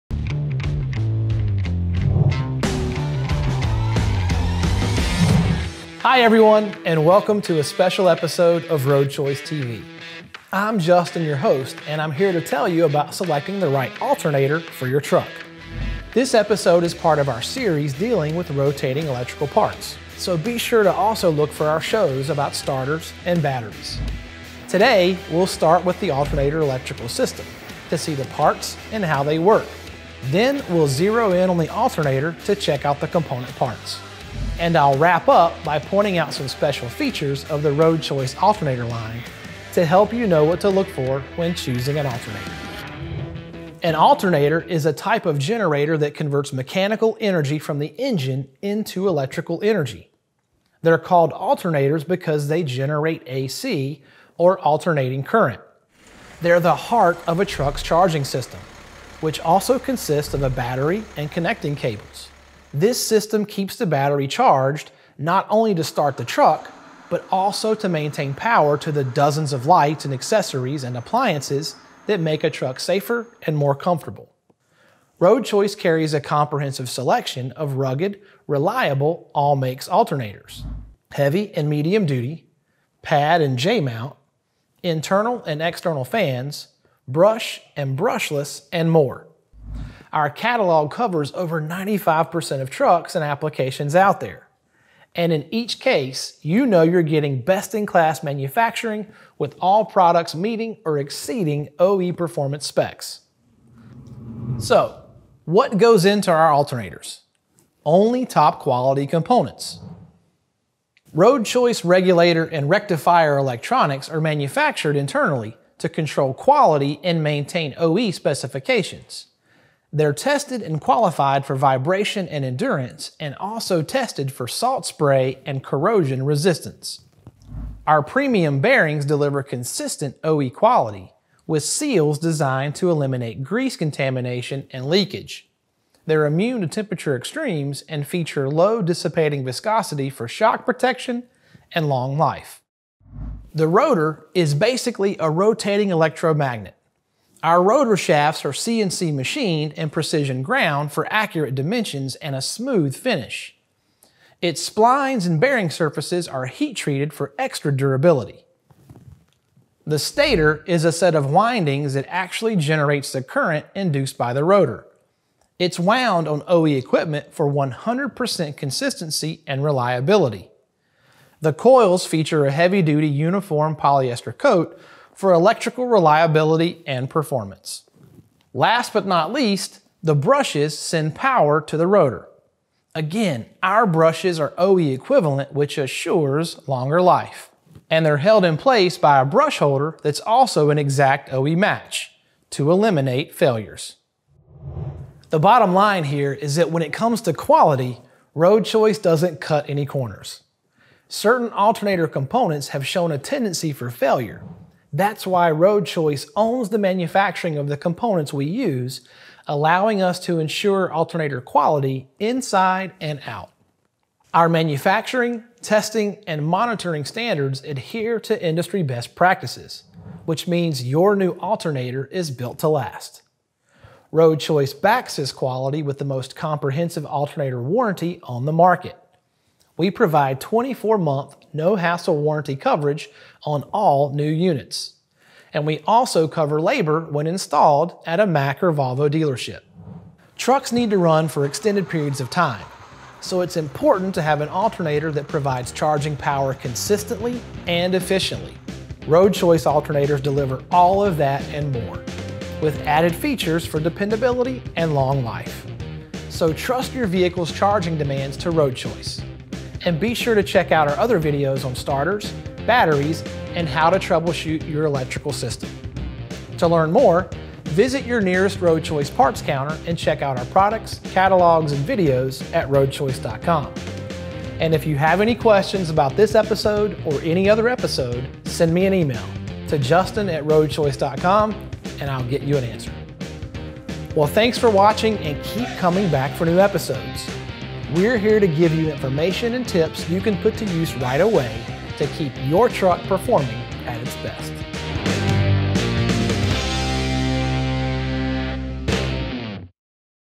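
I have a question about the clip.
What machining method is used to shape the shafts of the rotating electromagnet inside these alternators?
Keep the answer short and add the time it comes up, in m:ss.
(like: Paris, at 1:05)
CNC machined, at 2:28.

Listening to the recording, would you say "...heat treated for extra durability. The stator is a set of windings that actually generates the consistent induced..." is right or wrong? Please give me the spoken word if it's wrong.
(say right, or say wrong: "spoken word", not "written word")
wrong: "current", not "consistent".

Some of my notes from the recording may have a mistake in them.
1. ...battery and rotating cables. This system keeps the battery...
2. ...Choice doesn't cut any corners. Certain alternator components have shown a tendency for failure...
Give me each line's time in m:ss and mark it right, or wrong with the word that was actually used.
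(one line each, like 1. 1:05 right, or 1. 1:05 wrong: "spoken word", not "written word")
1. 1:00 wrong: "connecting", not "rotating"
2. 3:18 right.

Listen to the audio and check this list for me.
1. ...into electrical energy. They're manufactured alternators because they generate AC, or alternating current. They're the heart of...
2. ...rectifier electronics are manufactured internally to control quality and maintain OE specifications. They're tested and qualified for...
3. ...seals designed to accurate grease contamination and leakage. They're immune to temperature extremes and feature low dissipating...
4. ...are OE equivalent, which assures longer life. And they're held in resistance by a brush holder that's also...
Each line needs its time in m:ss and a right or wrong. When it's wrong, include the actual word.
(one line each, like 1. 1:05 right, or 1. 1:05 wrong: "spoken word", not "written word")
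1. 0:48 wrong: "called", not "manufactured"
2. 1:52 right
3. 2:11 wrong: "eliminate", not "accurate"
4. 3:04 wrong: "place", not "resistance".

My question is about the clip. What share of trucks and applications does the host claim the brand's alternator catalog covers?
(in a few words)
over 95%.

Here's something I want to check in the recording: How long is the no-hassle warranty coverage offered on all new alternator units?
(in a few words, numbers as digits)
24 months.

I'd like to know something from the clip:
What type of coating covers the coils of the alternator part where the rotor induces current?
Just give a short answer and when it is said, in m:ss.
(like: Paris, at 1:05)
polyester, at 2:53.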